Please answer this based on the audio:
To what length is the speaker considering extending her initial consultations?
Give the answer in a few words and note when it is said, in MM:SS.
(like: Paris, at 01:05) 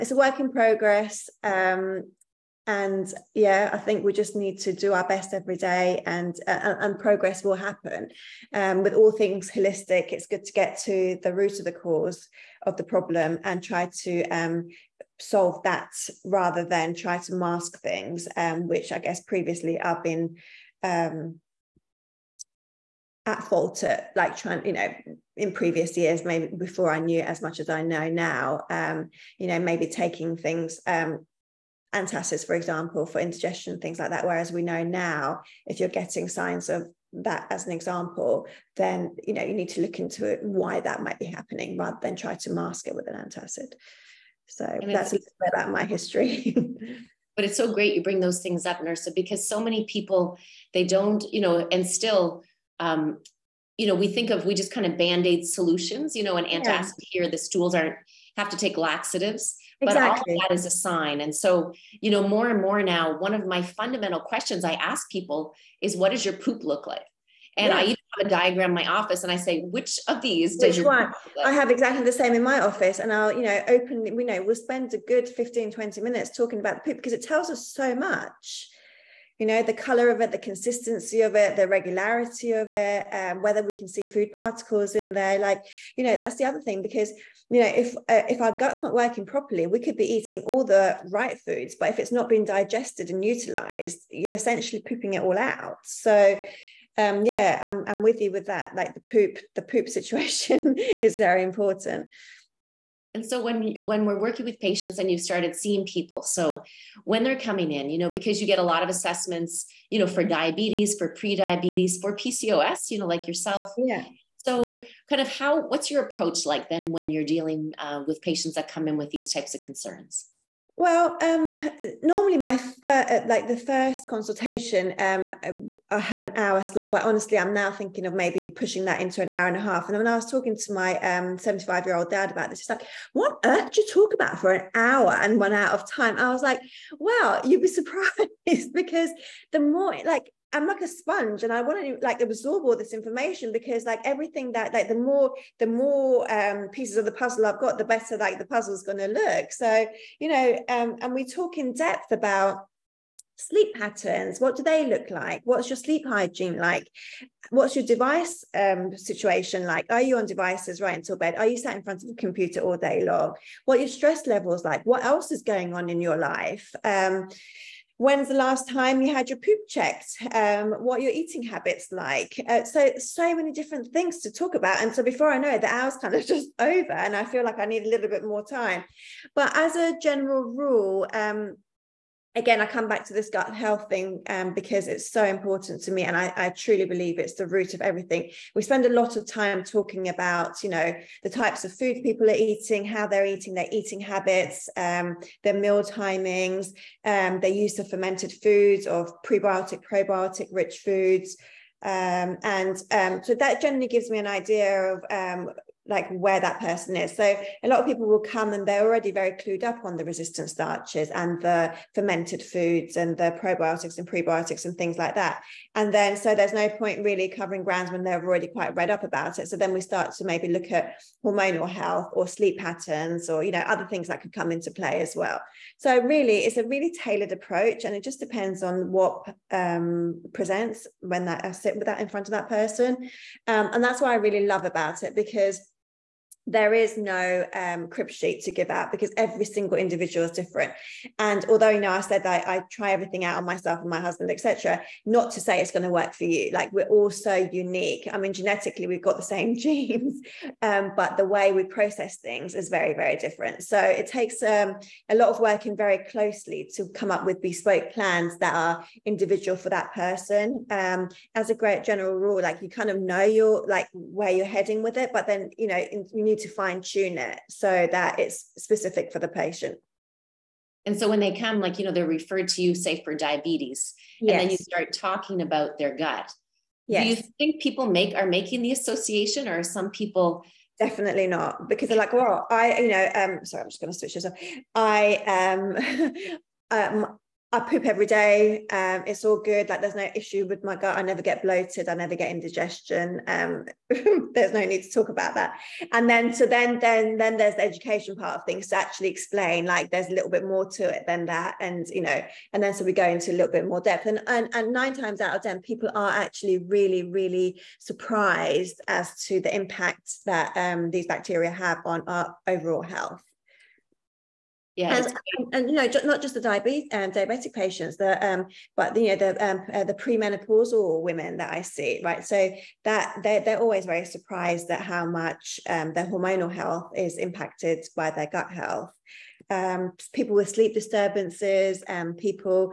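An hour and a half, at 02:09.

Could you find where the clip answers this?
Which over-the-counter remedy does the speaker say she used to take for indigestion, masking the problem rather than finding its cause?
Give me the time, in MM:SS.
00:31.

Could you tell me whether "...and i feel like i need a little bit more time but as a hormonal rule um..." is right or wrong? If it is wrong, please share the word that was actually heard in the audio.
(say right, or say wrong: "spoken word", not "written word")
wrong: "general", not "hormonal".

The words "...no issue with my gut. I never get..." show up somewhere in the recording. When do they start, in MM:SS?
04:49.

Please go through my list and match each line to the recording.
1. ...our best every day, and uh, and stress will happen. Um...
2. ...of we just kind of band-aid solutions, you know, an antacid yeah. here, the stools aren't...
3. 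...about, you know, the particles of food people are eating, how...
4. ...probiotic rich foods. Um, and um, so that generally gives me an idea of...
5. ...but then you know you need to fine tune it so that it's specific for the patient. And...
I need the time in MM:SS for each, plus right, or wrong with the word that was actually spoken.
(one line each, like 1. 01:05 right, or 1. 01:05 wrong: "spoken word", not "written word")
1. 00:04 wrong: "progress", not "stress"
2. 00:54 right
3. 03:10 wrong: "types", not "particles"
4. 03:19 right
5. 04:25 right.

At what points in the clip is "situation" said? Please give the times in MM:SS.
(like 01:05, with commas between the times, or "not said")
01:39, 02:38.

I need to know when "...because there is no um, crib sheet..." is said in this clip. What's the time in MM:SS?
03:55.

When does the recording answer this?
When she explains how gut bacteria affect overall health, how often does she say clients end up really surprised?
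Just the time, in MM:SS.
05:04.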